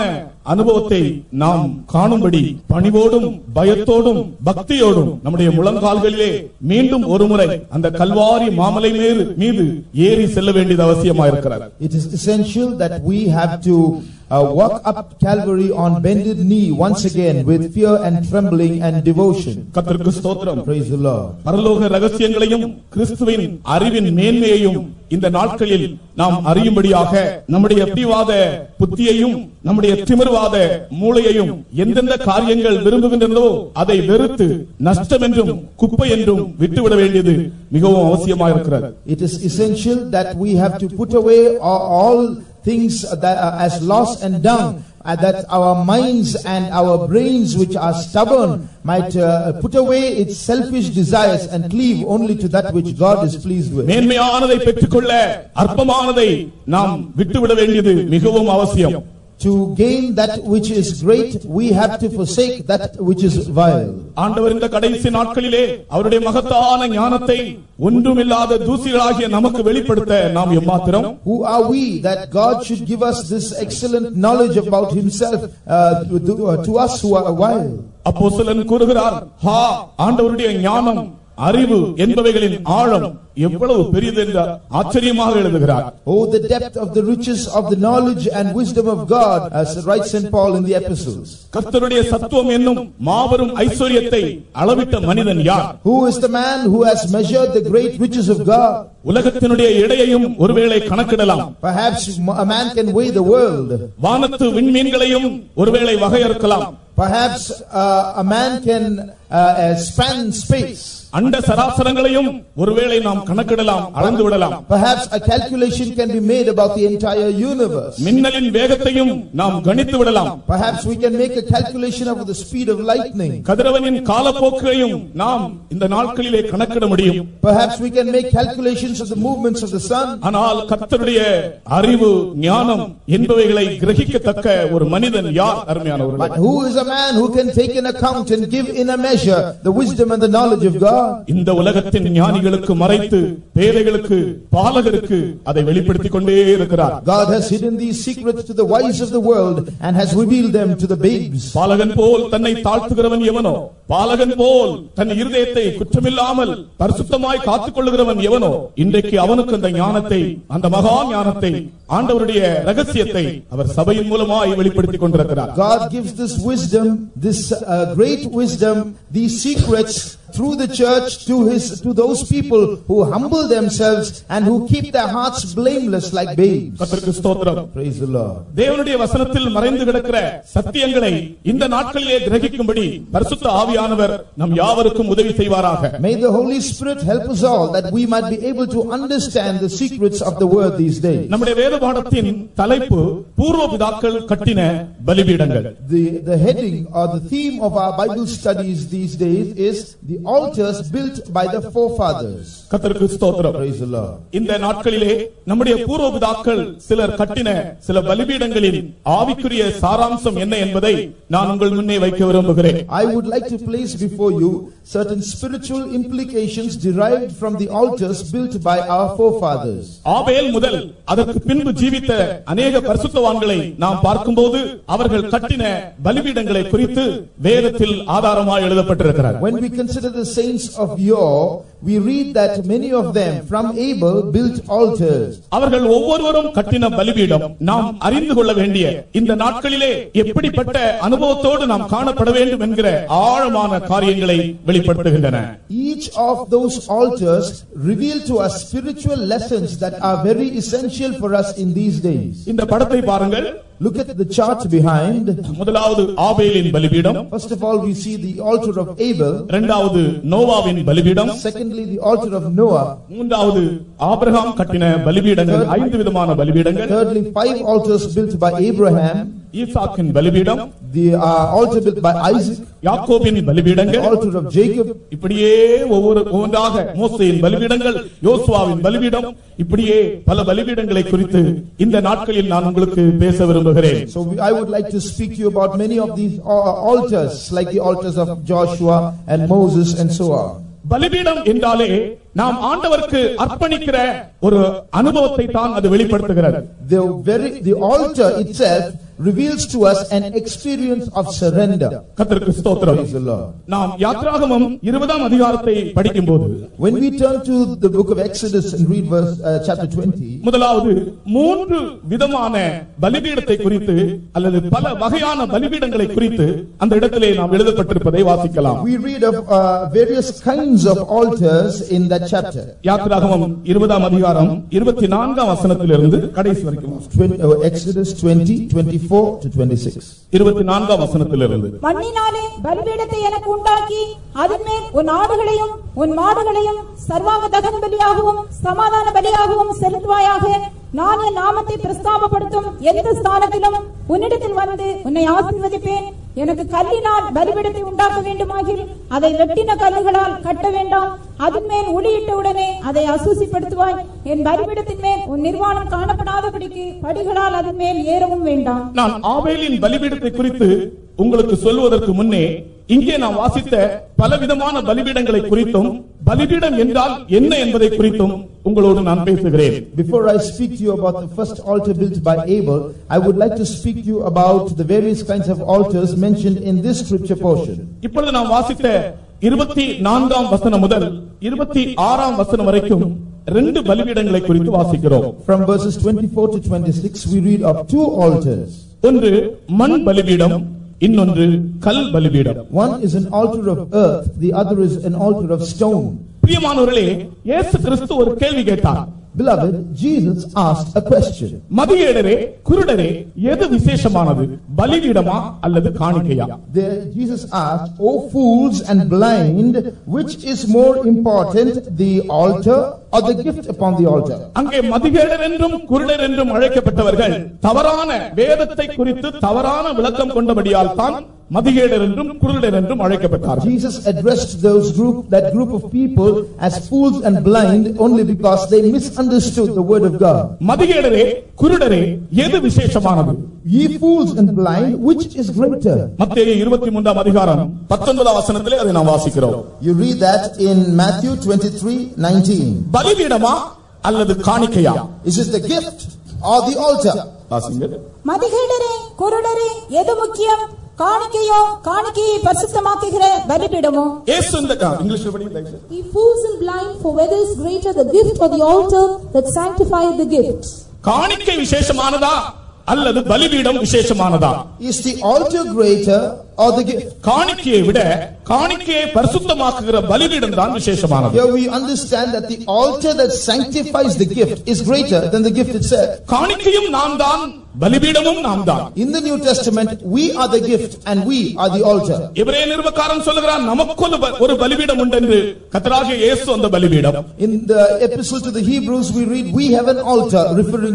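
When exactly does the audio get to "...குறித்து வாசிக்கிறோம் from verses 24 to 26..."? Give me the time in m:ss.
6:24.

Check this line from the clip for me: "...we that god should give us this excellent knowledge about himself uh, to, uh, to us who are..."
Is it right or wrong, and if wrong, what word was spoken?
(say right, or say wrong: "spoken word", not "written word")
right.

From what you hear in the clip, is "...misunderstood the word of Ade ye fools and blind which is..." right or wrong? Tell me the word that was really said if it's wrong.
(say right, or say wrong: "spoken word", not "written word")
wrong: "God", not "Ade".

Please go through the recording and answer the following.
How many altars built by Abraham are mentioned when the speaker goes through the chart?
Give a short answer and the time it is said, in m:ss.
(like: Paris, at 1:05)
5, at 4:27.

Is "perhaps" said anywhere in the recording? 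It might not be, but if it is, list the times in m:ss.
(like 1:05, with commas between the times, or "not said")
1:41, 1:46.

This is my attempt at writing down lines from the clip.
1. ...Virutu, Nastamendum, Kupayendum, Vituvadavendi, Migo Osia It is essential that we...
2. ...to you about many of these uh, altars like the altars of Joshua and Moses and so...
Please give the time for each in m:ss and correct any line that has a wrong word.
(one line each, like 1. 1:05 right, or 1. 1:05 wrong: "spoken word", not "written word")
1. 0:34 right
2. 4:45 right.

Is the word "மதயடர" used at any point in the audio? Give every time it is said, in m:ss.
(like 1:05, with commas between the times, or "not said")
6:41, 6:54.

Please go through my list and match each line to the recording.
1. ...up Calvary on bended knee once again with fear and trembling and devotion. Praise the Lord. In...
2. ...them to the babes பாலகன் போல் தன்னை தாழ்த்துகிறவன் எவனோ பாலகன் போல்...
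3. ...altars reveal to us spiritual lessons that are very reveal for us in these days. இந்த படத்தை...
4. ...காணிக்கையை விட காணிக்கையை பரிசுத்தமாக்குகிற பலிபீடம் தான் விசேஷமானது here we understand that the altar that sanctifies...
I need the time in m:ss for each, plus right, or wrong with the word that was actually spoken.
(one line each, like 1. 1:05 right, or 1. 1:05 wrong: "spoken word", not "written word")
1. 0:14 right
2. 2:30 right
3. 4:06 wrong: "essential", not "reveal"
4. 7:47 right.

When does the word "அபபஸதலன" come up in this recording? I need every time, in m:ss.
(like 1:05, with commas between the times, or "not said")
1:18.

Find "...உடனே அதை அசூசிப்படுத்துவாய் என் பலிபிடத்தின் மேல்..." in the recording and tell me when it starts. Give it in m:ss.
5:52.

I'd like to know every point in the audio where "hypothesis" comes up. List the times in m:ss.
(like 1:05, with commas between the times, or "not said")
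not said.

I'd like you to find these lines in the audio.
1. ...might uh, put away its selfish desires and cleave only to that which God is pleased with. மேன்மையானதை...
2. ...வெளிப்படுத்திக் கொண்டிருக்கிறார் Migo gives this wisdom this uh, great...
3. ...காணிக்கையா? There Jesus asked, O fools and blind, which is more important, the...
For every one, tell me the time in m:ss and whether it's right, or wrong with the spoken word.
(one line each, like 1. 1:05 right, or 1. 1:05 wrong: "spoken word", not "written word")
1. 0:48 right
2. 2:44 wrong: "God", not "Migo"
3. 6:45 right.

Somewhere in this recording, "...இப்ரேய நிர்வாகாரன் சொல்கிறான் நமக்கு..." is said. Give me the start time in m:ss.
8:02.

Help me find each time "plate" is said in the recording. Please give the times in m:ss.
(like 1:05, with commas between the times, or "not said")
not said.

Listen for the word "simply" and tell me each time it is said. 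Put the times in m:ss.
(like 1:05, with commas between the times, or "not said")
not said.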